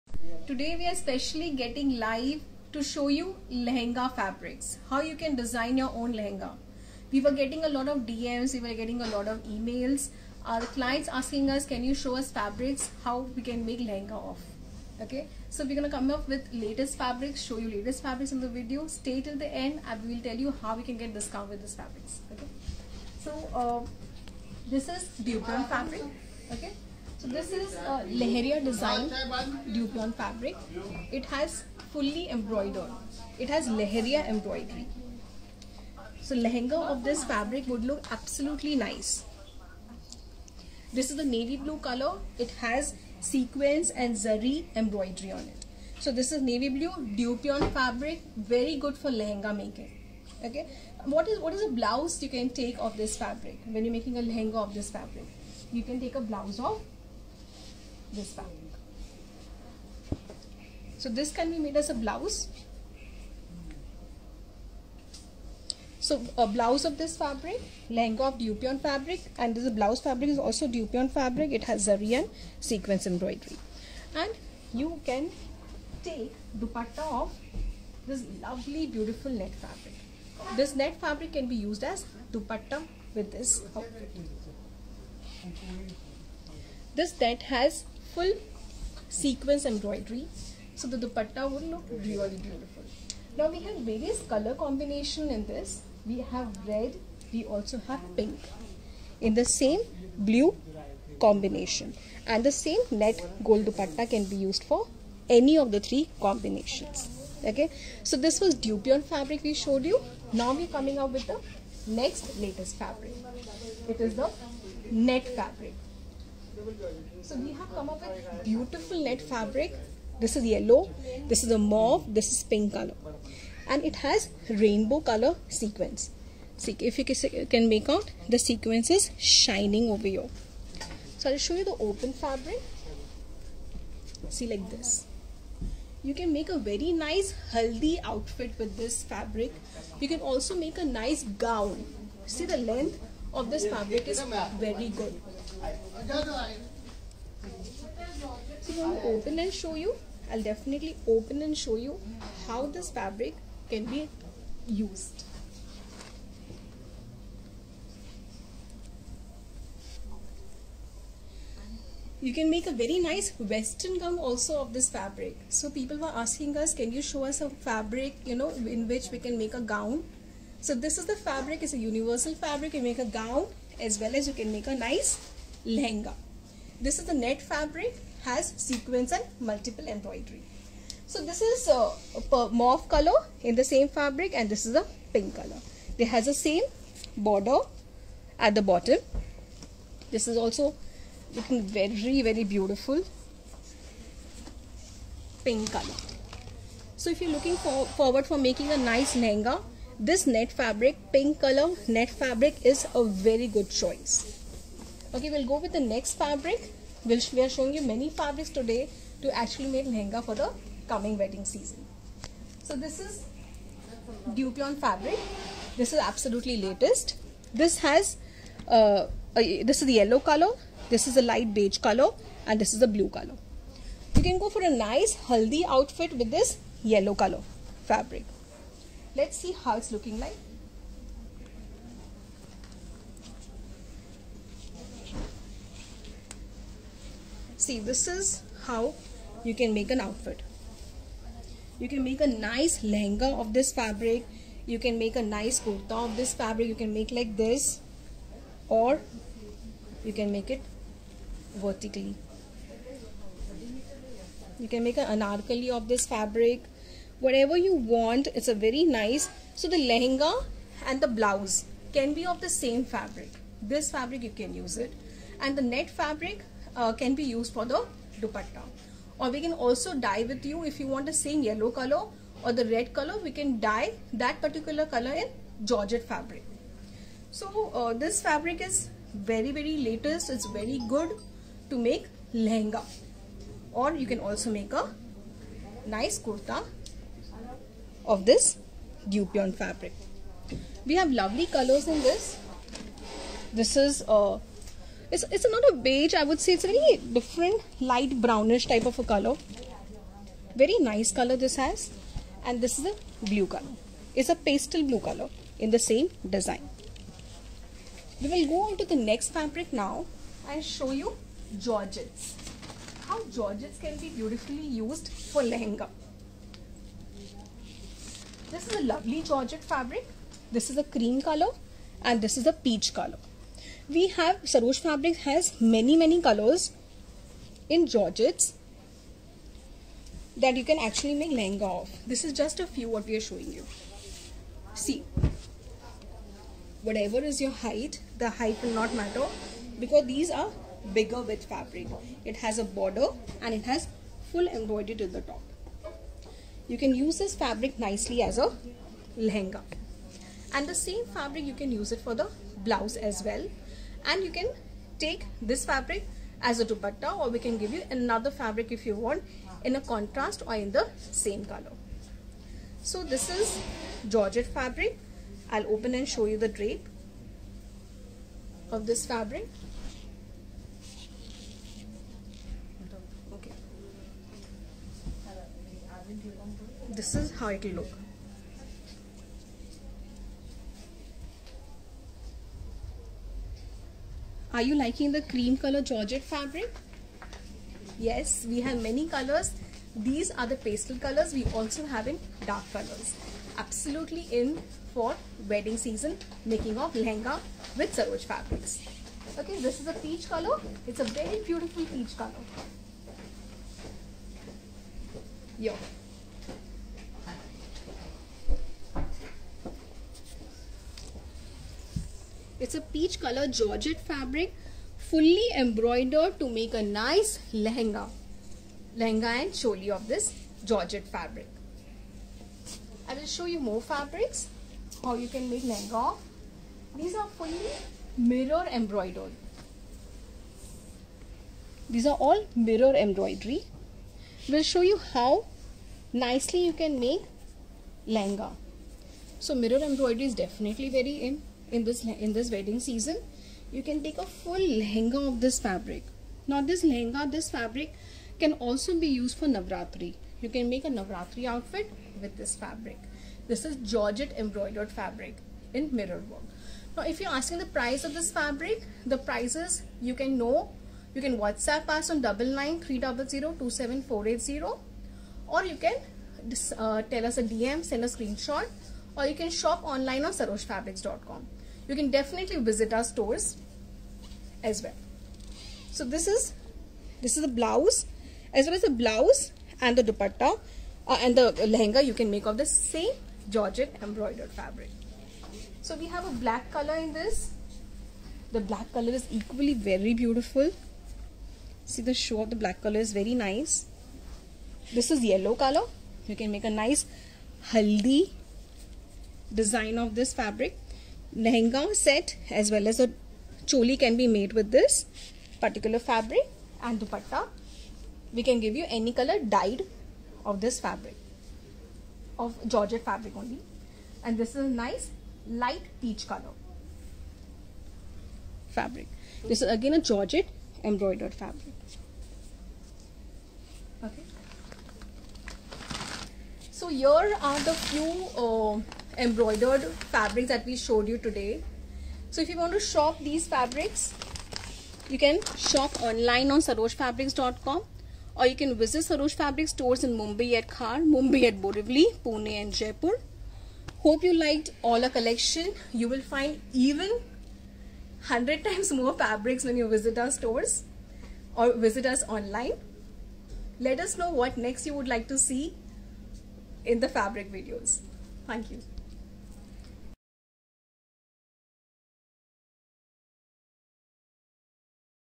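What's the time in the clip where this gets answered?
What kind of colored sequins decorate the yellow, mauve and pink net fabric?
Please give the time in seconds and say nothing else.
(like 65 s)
124 s.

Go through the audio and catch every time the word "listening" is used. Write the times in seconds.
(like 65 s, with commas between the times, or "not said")
not said.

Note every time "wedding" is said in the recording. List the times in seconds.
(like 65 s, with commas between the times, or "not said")
211 s, 395 s, 442 s.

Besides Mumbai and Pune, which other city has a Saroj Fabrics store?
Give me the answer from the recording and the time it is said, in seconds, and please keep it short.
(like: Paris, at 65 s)
Jaipur, at 542 s.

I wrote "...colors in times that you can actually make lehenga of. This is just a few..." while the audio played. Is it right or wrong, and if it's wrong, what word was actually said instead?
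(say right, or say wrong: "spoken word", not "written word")
wrong: "georgettes", not "times".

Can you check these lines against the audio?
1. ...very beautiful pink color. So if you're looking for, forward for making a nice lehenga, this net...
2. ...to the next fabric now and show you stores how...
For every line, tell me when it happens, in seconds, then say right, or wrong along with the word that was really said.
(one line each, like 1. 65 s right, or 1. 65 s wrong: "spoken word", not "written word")
1. 192 s right
2. 308 s wrong: "georgettes", not "stores".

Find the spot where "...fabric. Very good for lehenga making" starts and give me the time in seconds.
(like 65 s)
47 s.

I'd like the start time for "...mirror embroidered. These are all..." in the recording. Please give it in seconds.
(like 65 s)
428 s.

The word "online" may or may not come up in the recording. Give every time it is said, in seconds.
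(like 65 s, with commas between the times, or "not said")
469 s, 536 s, 552 s.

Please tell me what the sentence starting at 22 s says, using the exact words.
Okay, so uh, this is dupion fabric.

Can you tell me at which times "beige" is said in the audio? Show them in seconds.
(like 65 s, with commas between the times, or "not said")
221 s, 295 s.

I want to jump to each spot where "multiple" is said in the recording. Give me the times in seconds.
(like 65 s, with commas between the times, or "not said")
179 s.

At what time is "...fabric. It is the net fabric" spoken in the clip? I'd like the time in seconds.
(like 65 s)
112 s.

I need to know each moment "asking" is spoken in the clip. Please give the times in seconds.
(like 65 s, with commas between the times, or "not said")
11 s, 166 s, 457 s.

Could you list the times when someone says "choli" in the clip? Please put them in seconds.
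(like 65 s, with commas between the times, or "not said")
419 s, 503 s.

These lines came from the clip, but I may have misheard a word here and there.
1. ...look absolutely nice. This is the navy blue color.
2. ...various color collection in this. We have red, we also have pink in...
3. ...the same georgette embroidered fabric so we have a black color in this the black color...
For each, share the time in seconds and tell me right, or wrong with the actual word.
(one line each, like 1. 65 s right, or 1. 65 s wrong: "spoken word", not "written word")
1. 37 s right
2. 93 s wrong: "combination", not "collection"
3. 482 s right.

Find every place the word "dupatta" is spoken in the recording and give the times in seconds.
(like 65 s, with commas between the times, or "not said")
76 s, 82 s, 90 s, 103 s, 268 s, 356 s, 480 s, 506 s.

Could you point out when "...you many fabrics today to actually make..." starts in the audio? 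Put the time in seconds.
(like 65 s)
207 s.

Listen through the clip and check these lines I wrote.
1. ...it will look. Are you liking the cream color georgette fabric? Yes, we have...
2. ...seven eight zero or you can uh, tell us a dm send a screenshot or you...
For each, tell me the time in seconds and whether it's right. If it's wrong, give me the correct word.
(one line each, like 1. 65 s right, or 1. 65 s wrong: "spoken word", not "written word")
1. 377 s right
2. 464 s wrong: "four", not "seven".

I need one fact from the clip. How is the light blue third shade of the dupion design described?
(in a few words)
Pastel blue.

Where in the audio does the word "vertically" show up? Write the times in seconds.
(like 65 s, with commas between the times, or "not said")
251 s.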